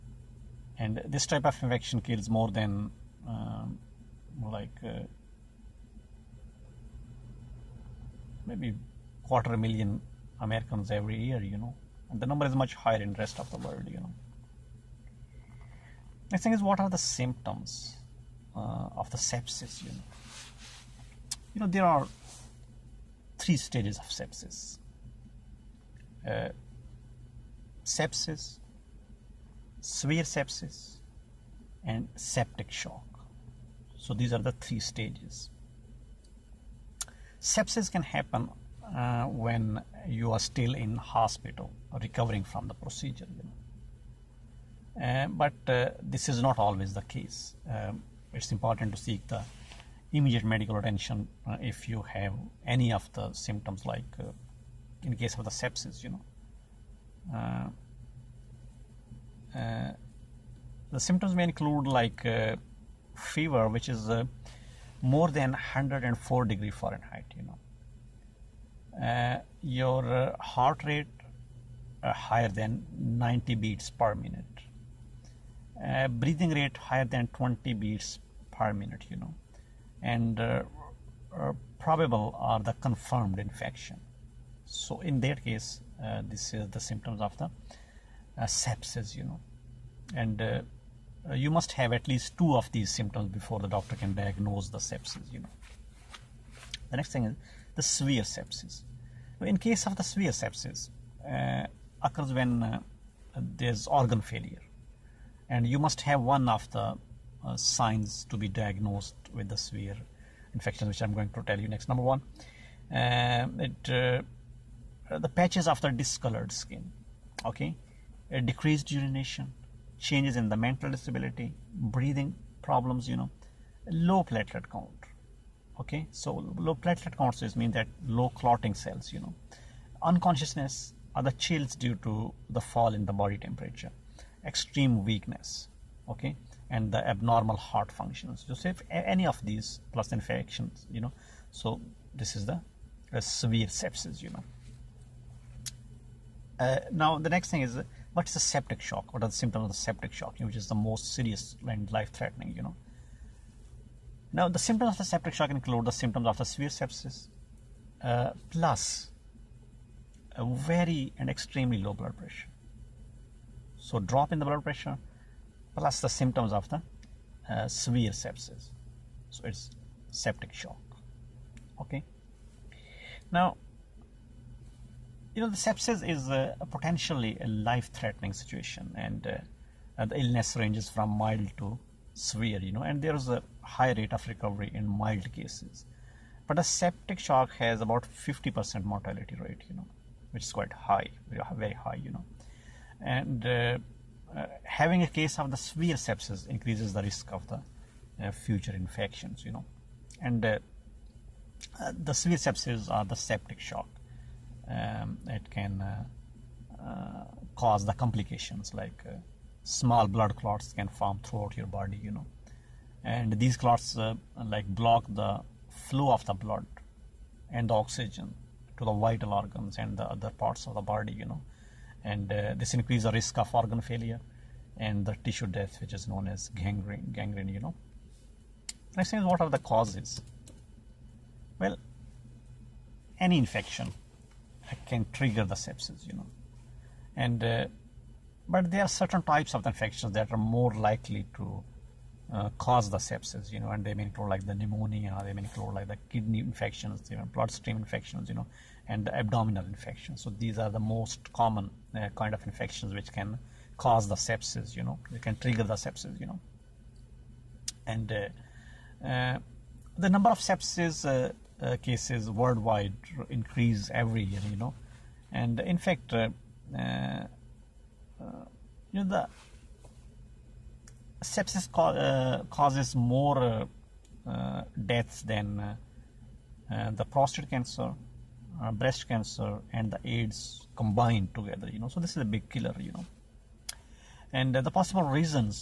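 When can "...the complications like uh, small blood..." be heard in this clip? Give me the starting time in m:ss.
3:27.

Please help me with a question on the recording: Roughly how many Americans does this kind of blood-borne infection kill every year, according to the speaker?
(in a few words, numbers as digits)
quarter million.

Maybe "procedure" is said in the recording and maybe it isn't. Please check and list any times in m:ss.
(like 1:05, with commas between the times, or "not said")
0:42.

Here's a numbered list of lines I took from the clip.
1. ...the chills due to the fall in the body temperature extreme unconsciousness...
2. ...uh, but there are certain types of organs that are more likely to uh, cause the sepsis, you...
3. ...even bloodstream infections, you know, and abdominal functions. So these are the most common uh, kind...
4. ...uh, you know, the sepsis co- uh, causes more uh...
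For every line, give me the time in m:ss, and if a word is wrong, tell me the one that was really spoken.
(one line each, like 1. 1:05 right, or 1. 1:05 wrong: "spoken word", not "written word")
1. 2:11 wrong: "weakness", not "unconsciousness"
2. 3:57 wrong: "infections", not "organs"
3. 4:07 wrong: "infections", not "functions"
4. 4:26 right.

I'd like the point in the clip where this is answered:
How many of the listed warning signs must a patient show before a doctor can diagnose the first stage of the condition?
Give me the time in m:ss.
1:32.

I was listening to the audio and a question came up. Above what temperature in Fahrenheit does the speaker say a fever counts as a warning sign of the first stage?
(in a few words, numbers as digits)
104.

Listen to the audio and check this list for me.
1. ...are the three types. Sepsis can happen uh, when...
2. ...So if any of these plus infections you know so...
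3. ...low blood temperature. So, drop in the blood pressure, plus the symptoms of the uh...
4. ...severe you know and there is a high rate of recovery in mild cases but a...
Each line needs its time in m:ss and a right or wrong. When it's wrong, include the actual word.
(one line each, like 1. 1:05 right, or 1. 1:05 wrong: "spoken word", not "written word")
1. 0:34 wrong: "stages", not "types"
2. 2:18 right
3. 2:41 wrong: "pressure", not "temperature"
4. 3:02 right.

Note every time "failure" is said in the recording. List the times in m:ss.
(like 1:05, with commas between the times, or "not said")
1:44, 3:43.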